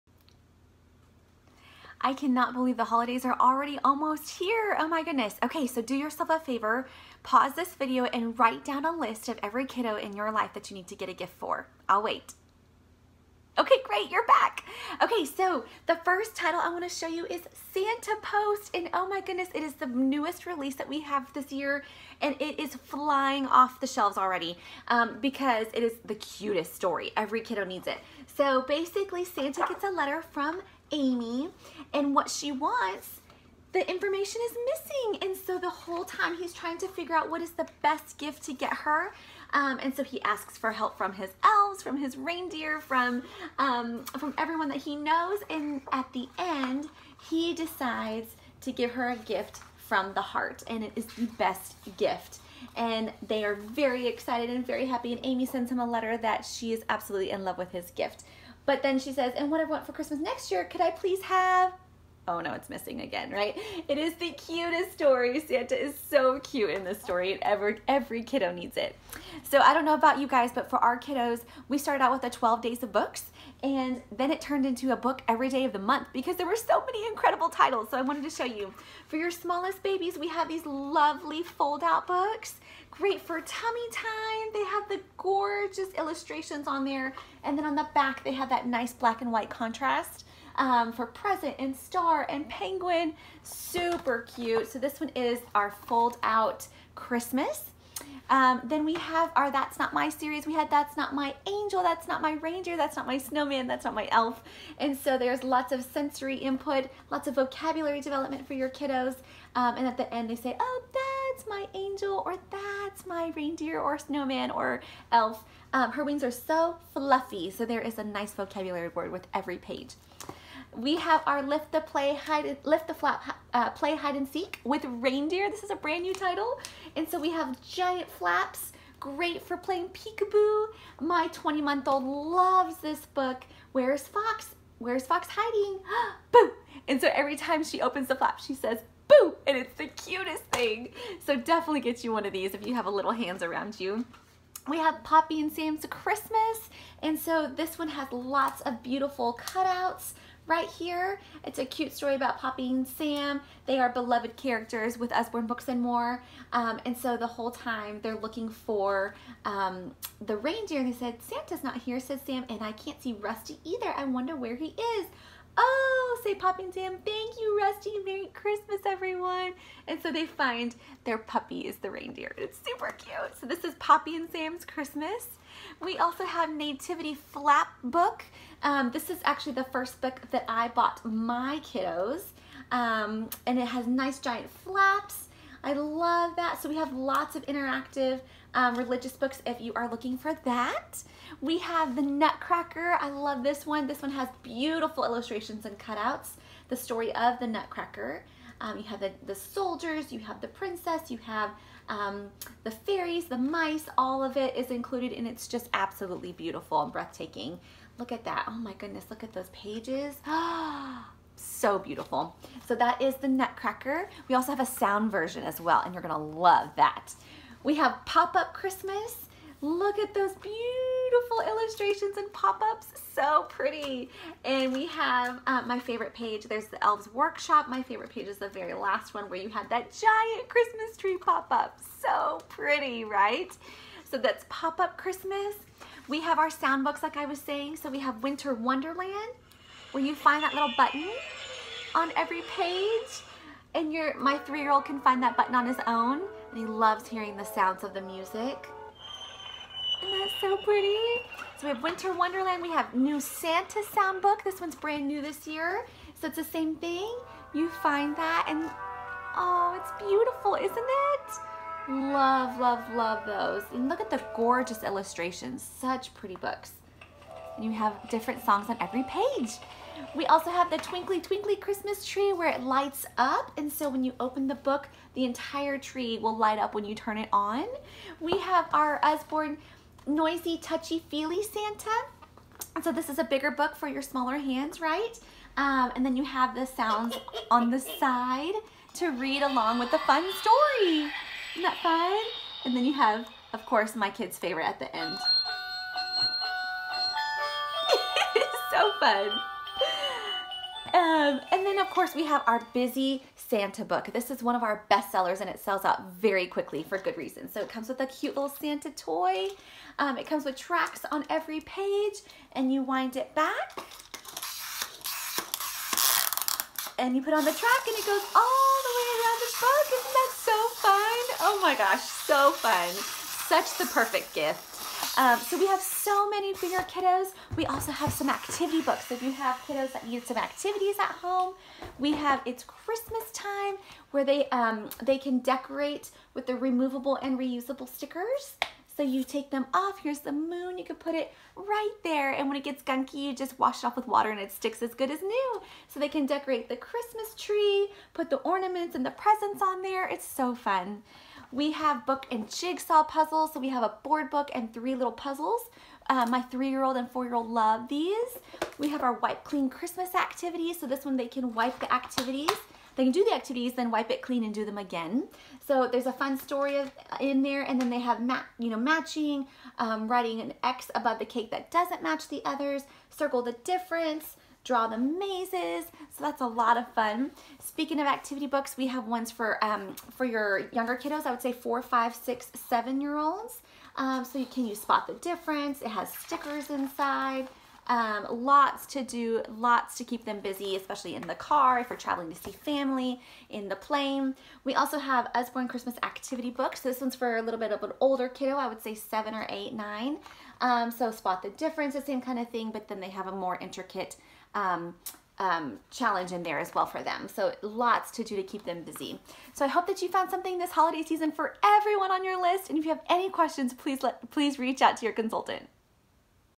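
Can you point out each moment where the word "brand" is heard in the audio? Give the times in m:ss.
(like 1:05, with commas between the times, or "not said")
2:05, 4:14.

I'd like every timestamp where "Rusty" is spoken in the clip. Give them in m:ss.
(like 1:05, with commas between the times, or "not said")
2:43, 2:47.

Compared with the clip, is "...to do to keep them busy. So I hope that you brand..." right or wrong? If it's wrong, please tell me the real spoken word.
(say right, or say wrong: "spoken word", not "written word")
wrong: "found", not "brand".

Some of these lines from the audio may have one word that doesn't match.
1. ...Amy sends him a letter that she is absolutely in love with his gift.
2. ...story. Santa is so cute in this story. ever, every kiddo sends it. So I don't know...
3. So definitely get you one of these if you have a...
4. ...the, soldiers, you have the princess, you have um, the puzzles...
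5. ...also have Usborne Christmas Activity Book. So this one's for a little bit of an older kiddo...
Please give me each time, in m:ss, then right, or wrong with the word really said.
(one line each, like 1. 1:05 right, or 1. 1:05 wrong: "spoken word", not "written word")
1. 0:55 right
2. 1:04 wrong: "needs", not "sends"
3. 2:21 right
4. 3:19 wrong: "fairies", not "puzzles"
5. 6:34 right.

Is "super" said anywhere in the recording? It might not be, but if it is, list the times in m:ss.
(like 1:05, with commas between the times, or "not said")
1:33, 2:52.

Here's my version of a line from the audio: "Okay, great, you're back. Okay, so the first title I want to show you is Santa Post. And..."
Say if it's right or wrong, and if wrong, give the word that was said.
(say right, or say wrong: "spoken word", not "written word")
right.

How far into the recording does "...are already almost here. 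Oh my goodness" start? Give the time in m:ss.
0:03.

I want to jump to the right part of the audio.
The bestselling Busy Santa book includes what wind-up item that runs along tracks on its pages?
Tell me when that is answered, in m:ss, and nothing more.
5:08.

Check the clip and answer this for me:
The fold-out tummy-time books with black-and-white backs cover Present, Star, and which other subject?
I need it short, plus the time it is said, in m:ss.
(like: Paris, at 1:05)
Penguin, at 1:32.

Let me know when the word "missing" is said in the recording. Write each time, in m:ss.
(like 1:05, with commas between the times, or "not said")
0:34, 1:02.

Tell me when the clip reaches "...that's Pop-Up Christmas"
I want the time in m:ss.
3:54.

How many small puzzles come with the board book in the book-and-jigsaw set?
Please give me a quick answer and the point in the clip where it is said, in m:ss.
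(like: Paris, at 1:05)
3, at 5:54.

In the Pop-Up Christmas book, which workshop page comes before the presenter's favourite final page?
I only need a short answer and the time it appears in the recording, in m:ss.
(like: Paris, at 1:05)
Elves Workshop, at 3:46.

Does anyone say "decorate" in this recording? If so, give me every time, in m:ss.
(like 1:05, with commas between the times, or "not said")
5:35, 5:46.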